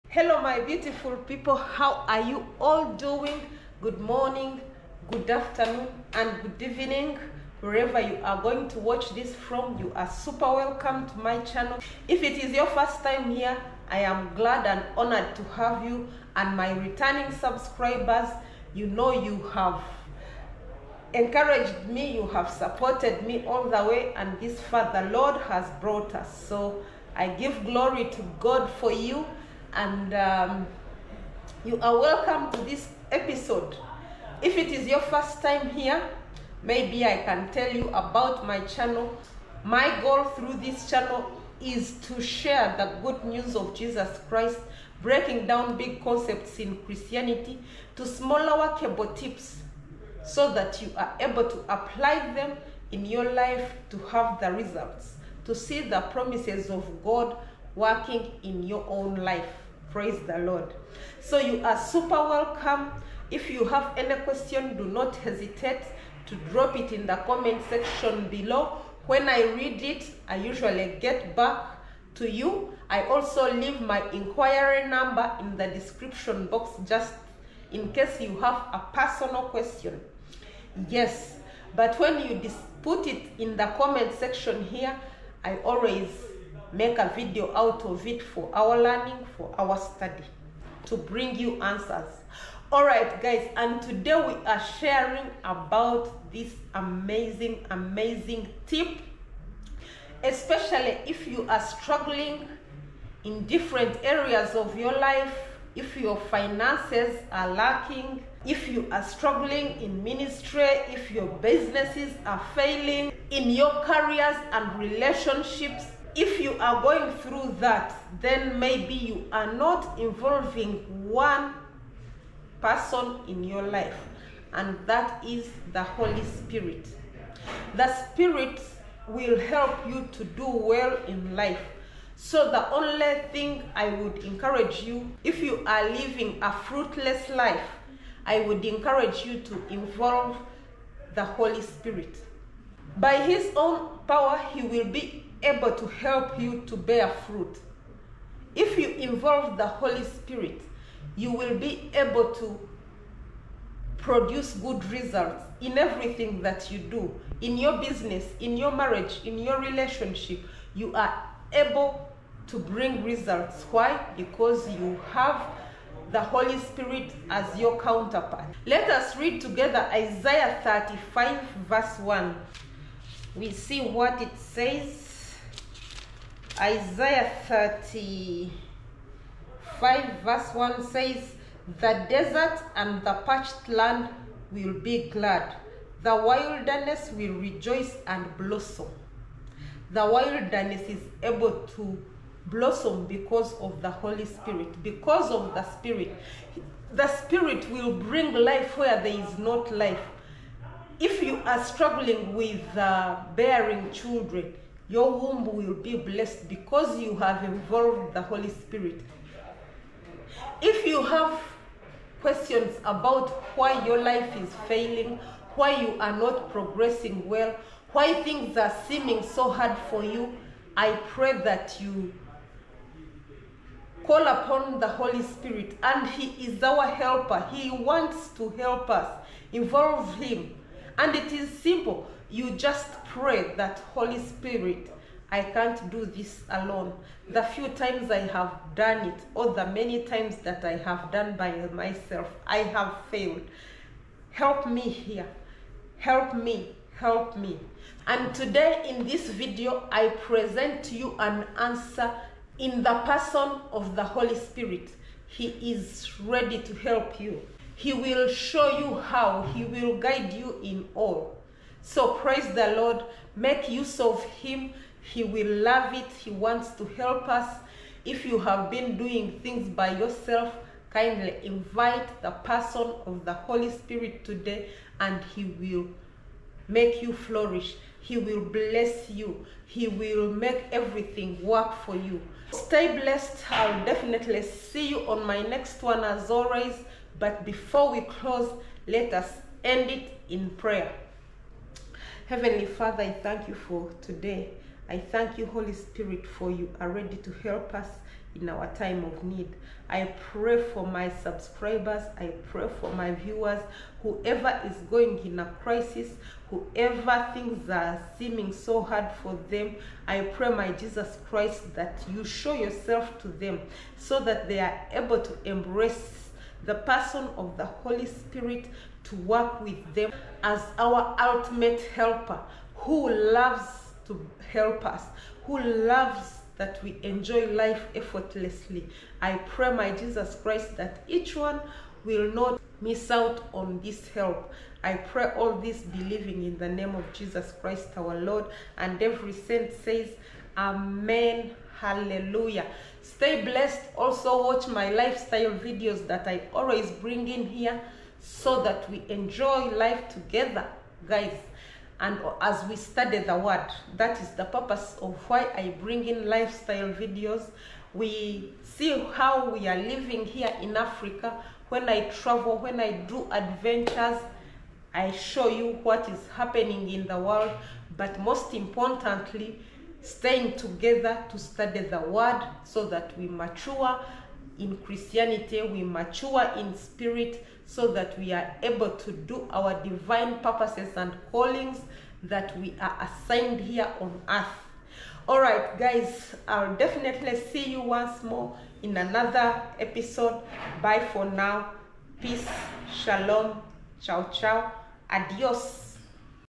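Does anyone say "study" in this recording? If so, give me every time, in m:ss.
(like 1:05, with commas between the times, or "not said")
1:29, 5:52, 6:11.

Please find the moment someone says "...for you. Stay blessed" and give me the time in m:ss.
4:41.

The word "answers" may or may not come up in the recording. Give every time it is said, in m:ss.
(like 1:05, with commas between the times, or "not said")
1:31, 4:11.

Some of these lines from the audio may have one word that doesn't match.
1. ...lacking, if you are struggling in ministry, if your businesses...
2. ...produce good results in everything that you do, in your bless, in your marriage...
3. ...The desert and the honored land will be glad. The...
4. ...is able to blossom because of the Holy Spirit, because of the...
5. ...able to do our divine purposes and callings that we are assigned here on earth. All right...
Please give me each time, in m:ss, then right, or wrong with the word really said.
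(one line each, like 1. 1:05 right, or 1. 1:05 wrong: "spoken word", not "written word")
1. 1:47 right
2. 2:33 wrong: "business", not "bless"
3. 3:01 wrong: "parched", not "honored"
4. 3:10 right
5. 6:18 right.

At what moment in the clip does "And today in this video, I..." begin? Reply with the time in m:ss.
4:08.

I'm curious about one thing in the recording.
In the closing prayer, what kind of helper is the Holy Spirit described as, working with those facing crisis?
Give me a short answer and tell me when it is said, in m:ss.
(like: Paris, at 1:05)
Ultimate helper, at 5:21.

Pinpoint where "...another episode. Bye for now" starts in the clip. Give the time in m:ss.
6:28.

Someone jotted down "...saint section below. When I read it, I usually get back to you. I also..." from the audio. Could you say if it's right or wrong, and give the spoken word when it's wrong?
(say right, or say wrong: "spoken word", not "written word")
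wrong: "comment", not "saint".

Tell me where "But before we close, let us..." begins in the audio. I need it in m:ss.
4:47.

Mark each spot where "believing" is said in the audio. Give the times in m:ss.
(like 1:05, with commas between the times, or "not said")
5:35.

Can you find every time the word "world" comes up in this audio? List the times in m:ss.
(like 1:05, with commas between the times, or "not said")
6:07.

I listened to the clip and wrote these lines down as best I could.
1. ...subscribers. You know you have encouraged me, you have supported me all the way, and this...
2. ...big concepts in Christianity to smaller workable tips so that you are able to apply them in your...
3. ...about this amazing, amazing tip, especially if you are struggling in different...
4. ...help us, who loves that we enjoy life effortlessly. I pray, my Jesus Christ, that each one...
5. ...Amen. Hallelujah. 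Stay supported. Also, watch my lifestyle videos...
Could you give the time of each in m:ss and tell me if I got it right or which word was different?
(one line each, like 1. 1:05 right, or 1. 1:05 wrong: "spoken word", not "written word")
1. 0:17 right
2. 0:45 right
3. 1:35 right
4. 5:24 right
5. 5:40 wrong: "blessed", not "supported".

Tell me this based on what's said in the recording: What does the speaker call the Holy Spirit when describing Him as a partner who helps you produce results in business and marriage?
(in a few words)
Counterpart.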